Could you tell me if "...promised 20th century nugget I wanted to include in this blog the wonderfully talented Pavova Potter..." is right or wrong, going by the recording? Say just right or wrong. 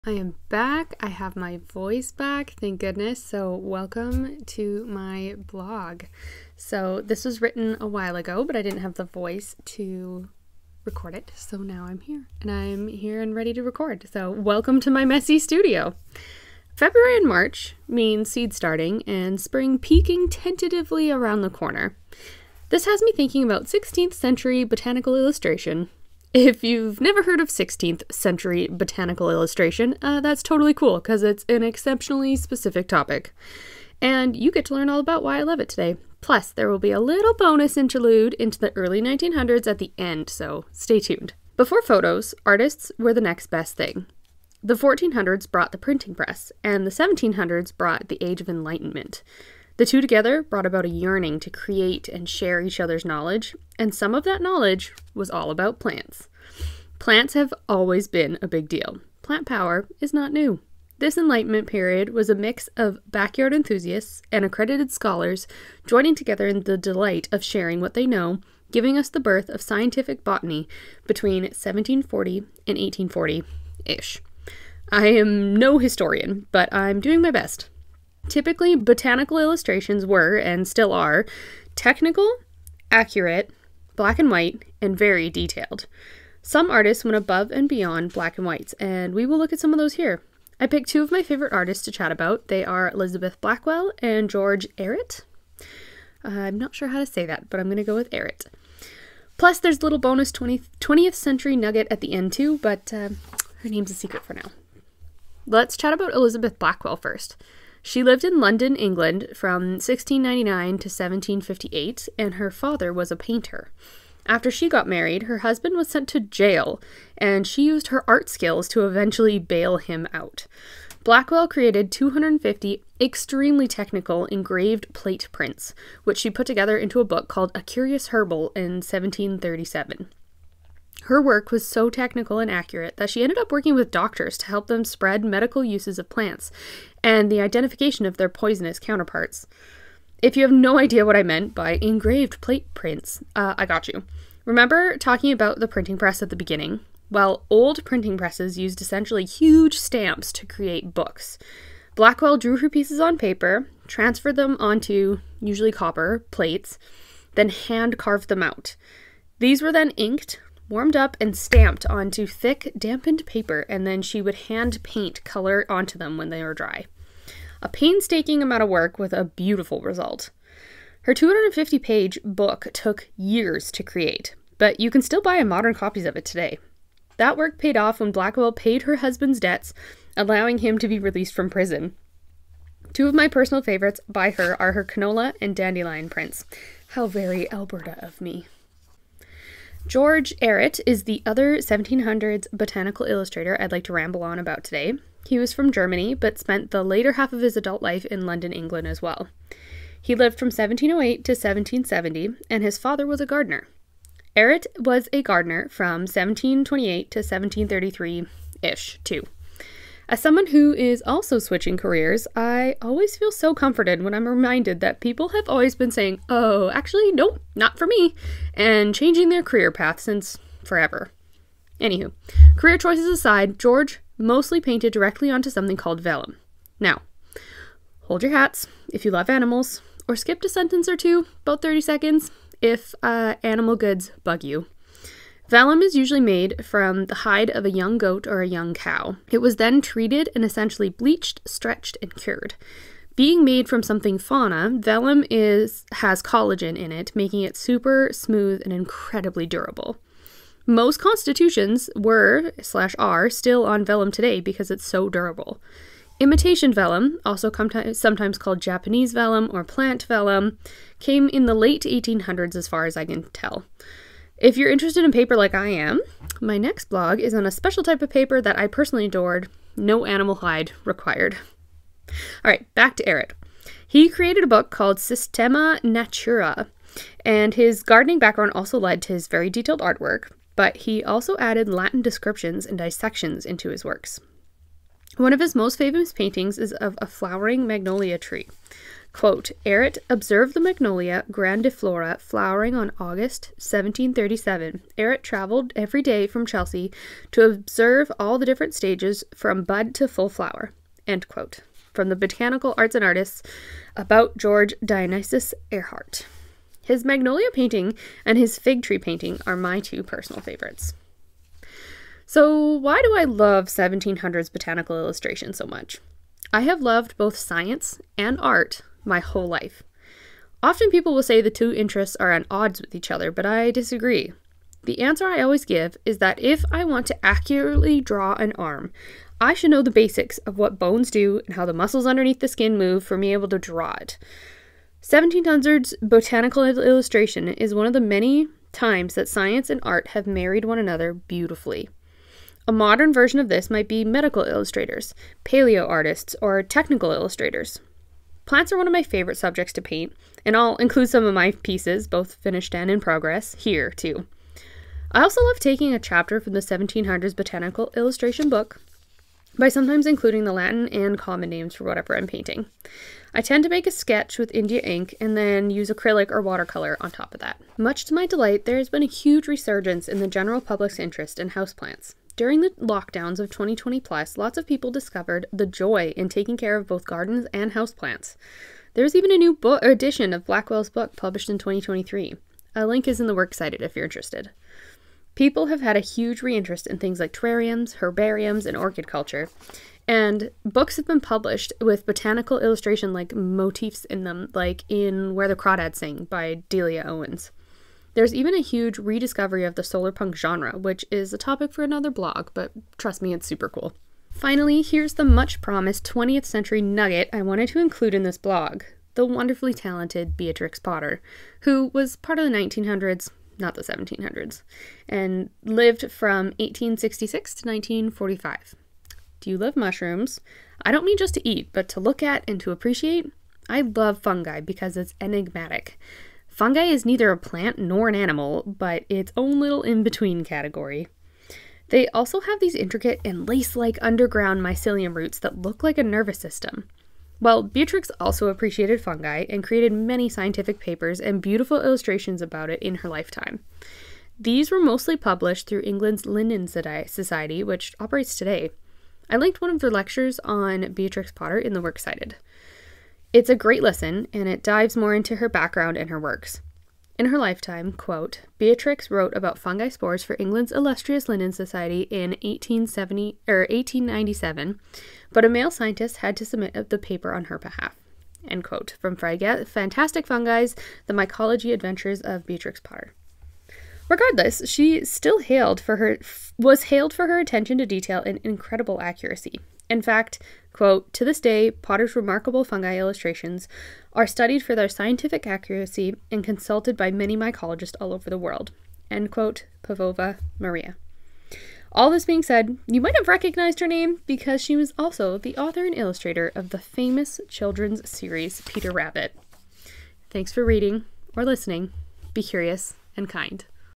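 wrong.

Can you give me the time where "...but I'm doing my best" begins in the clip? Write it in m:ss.
1:16.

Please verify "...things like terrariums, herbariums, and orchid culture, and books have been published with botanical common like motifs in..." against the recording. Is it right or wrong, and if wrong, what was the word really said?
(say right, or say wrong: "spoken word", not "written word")
wrong: "illustration", not "common".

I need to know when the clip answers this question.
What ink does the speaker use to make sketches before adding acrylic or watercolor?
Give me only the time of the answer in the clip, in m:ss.
6:04.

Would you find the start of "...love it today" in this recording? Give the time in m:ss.
0:35.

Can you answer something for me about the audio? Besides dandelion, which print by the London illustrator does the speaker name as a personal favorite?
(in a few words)
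Canola.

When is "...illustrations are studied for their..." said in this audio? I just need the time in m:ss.
8:02.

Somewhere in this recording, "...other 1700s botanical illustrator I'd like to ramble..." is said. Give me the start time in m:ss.
3:11.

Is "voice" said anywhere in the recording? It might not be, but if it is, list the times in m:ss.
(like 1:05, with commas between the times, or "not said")
0:01, 0:09.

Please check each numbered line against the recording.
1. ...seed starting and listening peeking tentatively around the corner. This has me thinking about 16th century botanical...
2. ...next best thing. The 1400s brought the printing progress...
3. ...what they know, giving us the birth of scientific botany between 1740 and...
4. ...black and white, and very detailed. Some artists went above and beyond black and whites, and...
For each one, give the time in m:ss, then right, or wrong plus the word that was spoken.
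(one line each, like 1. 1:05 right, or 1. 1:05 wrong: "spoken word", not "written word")
1. 0:18 wrong: "spring", not "listening"
2. 0:43 wrong: "press", not "progress"
3. 1:07 right
4. 1:23 right.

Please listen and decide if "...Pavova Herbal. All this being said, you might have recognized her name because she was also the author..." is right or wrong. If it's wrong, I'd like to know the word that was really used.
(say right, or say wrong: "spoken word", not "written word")
wrong: "Maria", not "Herbal".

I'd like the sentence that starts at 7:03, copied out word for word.
I love fungi because it's enigmatic.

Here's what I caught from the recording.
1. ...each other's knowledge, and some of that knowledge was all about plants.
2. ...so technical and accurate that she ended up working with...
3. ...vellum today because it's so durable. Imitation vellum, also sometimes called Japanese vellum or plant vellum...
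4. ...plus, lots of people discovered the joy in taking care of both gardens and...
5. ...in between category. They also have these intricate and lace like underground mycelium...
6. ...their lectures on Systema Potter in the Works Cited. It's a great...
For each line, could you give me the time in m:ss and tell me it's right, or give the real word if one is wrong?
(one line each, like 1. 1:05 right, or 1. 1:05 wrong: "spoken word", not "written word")
1. 0:52 right
2. 2:11 right
3. 4:13 right
4. 6:13 right
5. 7:09 right
6. 7:29 wrong: "Beatrix", not "Systema".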